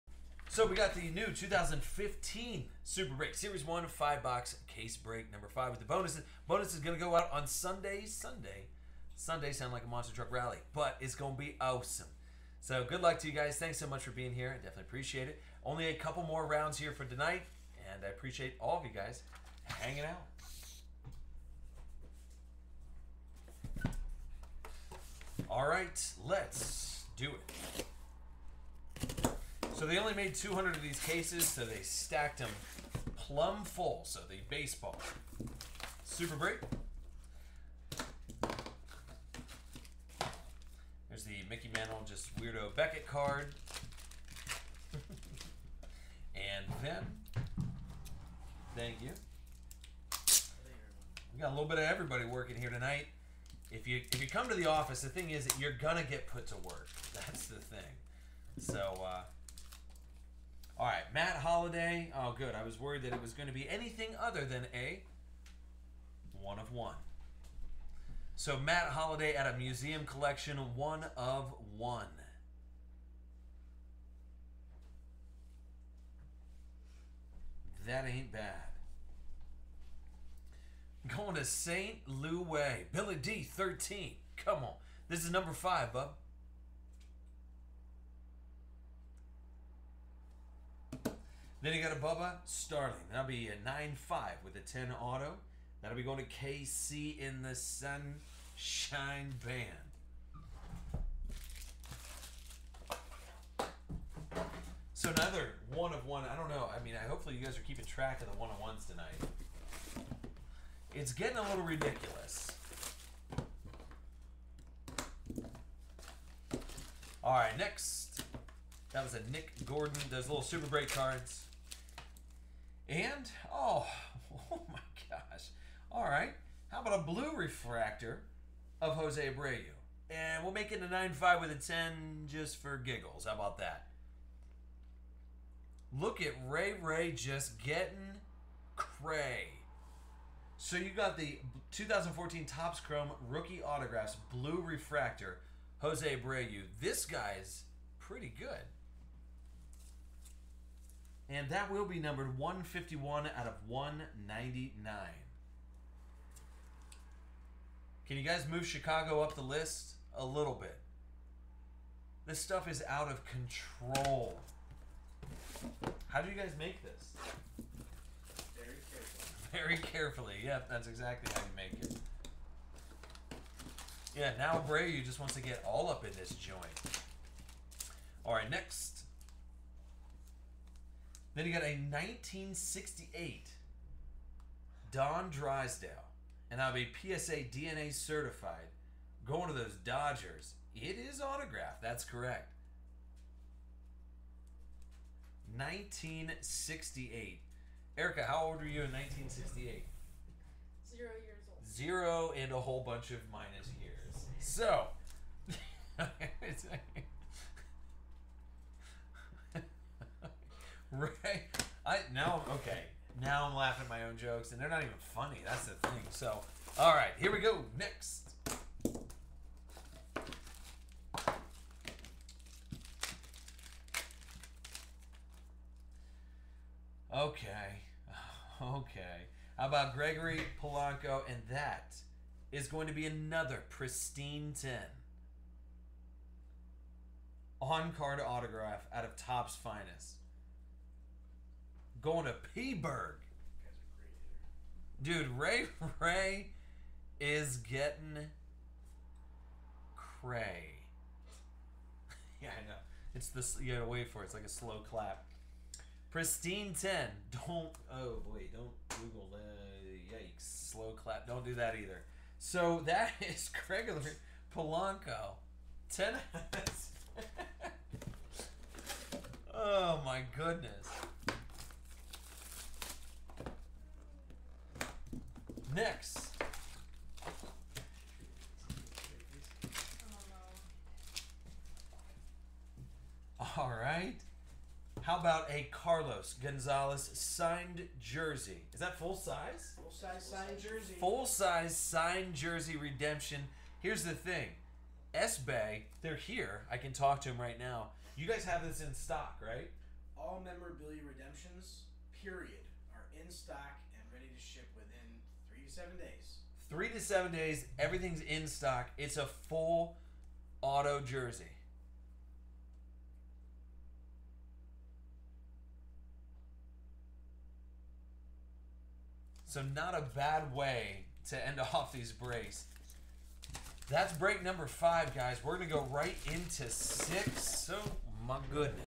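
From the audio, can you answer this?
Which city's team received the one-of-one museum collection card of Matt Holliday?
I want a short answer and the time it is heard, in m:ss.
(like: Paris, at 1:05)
St. Louis, at 1:21.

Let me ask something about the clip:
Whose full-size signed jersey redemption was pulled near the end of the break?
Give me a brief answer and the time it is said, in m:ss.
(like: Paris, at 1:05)
Carlos Gonzalez, at 4:45.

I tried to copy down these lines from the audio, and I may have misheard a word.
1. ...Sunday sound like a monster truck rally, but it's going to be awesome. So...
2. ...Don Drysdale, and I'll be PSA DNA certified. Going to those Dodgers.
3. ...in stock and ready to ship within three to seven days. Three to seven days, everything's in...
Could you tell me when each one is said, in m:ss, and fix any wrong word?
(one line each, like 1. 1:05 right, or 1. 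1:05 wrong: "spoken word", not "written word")
1. 0:09 right
2. 3:04 right
3. 5:03 right.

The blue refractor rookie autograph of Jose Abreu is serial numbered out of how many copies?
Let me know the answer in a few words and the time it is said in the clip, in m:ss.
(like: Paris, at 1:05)
199, at 2:33.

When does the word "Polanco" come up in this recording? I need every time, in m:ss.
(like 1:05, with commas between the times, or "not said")
3:50, 4:24.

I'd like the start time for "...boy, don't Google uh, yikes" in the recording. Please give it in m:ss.
4:18.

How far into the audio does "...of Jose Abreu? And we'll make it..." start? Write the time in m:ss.
2:08.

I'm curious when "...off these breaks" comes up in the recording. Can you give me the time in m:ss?
5:21.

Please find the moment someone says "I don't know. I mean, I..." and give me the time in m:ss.
1:46.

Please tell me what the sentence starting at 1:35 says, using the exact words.
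That'll be going to KC in the Sunshine Band.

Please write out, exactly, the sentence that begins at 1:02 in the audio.
I was worried that it was going to be anything other than a one of one.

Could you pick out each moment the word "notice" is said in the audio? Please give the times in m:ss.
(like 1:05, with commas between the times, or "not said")
not said.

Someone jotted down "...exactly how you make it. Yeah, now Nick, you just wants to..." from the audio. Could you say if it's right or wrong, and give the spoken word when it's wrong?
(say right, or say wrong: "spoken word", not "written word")
wrong: "Bray", not "Nick".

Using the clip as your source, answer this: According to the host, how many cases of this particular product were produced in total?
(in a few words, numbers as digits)
200.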